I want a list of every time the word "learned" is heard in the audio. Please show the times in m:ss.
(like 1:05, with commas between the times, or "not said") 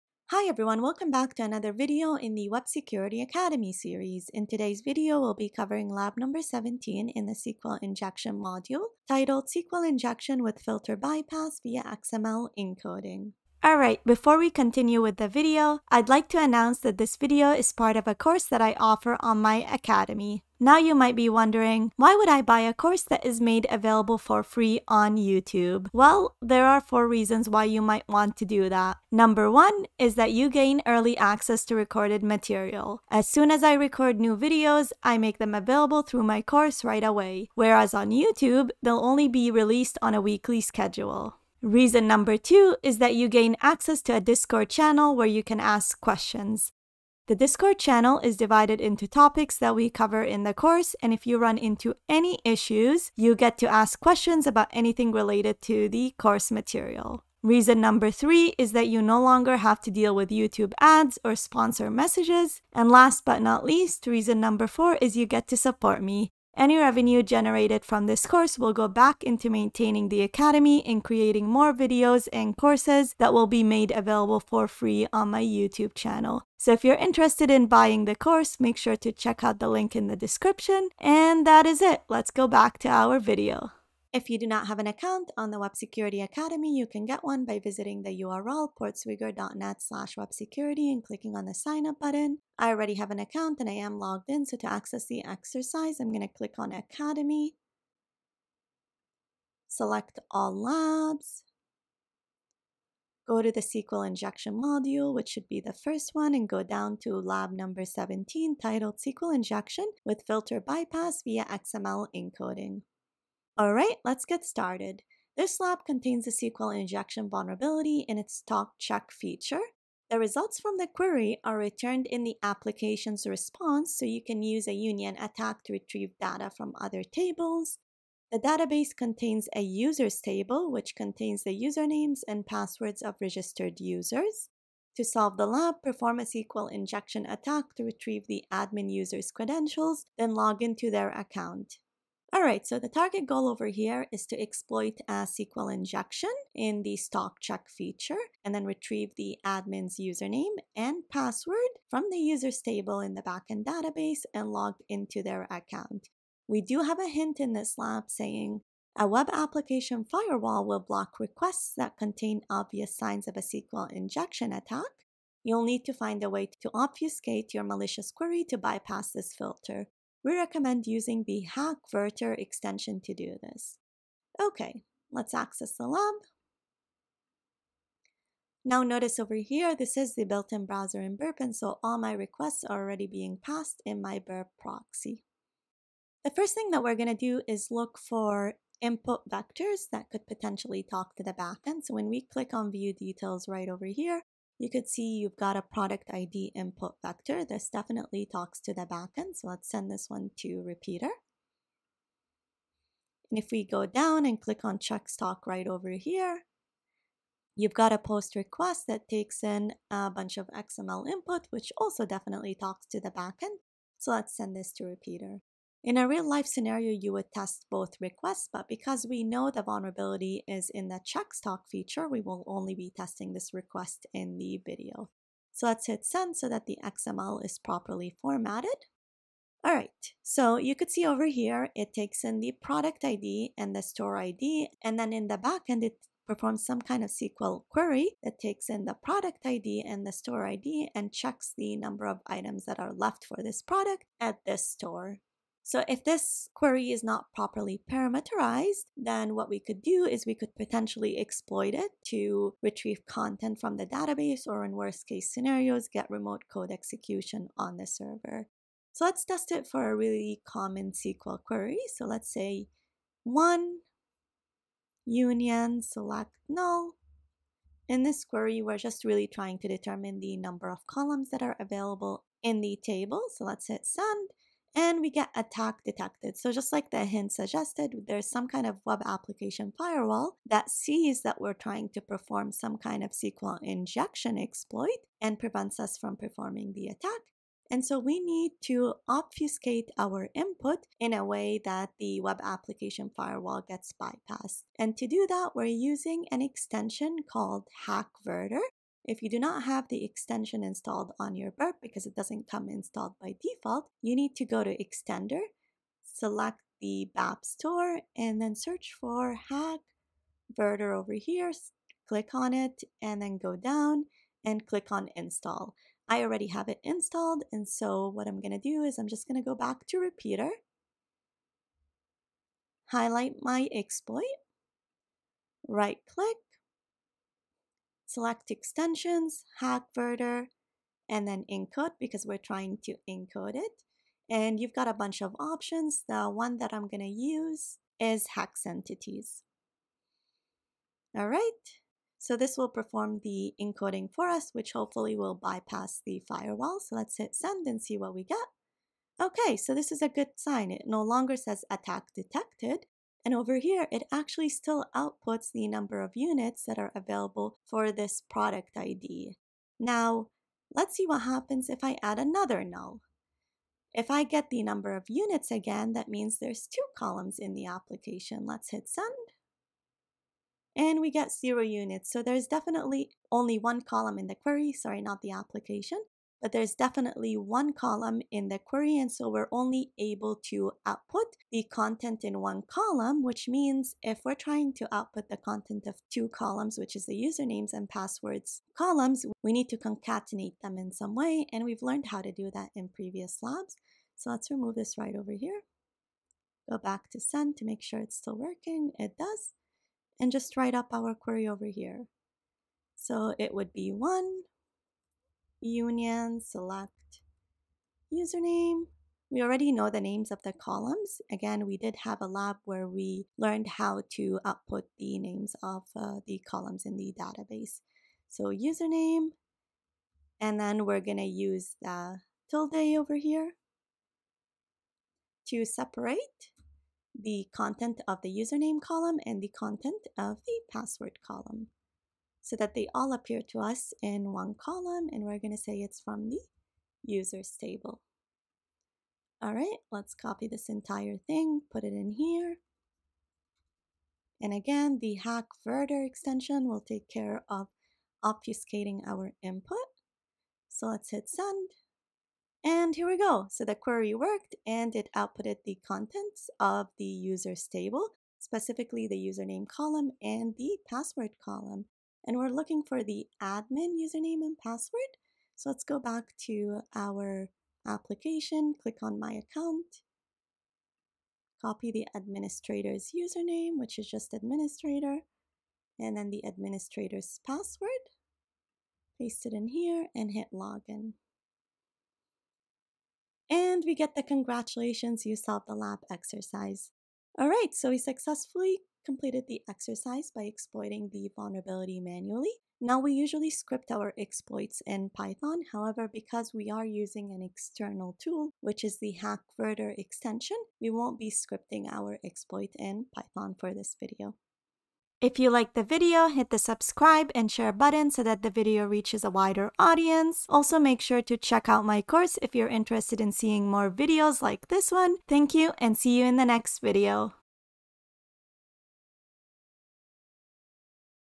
6:31, 6:53.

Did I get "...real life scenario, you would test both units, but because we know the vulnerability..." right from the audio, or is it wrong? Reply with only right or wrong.
wrong.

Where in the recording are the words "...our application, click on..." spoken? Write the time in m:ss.
7:46.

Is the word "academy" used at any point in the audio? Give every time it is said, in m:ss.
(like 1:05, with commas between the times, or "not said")
0:03, 0:19, 1:10, 1:26, 1:36.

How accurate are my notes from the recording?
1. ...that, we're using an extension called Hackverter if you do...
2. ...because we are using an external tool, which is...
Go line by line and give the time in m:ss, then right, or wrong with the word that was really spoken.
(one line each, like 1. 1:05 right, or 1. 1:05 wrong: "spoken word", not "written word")
1. 4:55 right
2. 8:16 right.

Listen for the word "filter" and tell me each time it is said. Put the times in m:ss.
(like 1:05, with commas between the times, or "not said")
0:10, 1:50, 2:49.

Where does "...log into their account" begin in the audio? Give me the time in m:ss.
2:20.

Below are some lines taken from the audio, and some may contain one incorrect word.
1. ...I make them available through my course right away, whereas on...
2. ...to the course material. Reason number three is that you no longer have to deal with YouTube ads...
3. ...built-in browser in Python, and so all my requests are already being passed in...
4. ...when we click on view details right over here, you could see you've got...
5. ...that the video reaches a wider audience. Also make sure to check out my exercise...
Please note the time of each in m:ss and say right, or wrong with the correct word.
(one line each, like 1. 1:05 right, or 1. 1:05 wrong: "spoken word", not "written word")
1. 0:35 right
2. 0:55 right
3. 3:00 wrong: "Burp", not "Python"
4. 3:11 right
5. 8:28 wrong: "course", not "exercise".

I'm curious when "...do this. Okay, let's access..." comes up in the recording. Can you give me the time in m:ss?
2:53.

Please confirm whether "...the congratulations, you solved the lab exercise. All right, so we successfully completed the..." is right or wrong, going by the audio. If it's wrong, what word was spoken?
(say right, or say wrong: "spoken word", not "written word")
right.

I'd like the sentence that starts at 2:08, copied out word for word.
The database contains a users table which contains the usernames and passwords of registered users.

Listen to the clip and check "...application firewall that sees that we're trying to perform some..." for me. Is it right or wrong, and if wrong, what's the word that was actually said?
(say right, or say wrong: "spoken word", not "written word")
right.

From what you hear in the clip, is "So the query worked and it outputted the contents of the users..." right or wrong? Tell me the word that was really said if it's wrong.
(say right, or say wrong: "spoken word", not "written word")
right.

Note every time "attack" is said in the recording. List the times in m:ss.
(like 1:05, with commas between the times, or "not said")
2:05, 2:17, 2:44, 4:35, 4:46, 5:51.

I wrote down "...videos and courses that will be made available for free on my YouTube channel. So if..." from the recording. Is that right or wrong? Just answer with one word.
right.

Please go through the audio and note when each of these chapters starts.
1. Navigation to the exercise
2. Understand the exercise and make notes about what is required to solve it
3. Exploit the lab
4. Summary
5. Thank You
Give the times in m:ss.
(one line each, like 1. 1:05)
1. 1:24
2. 1:52
3. 2:57
4. 8:07
5. 8:25.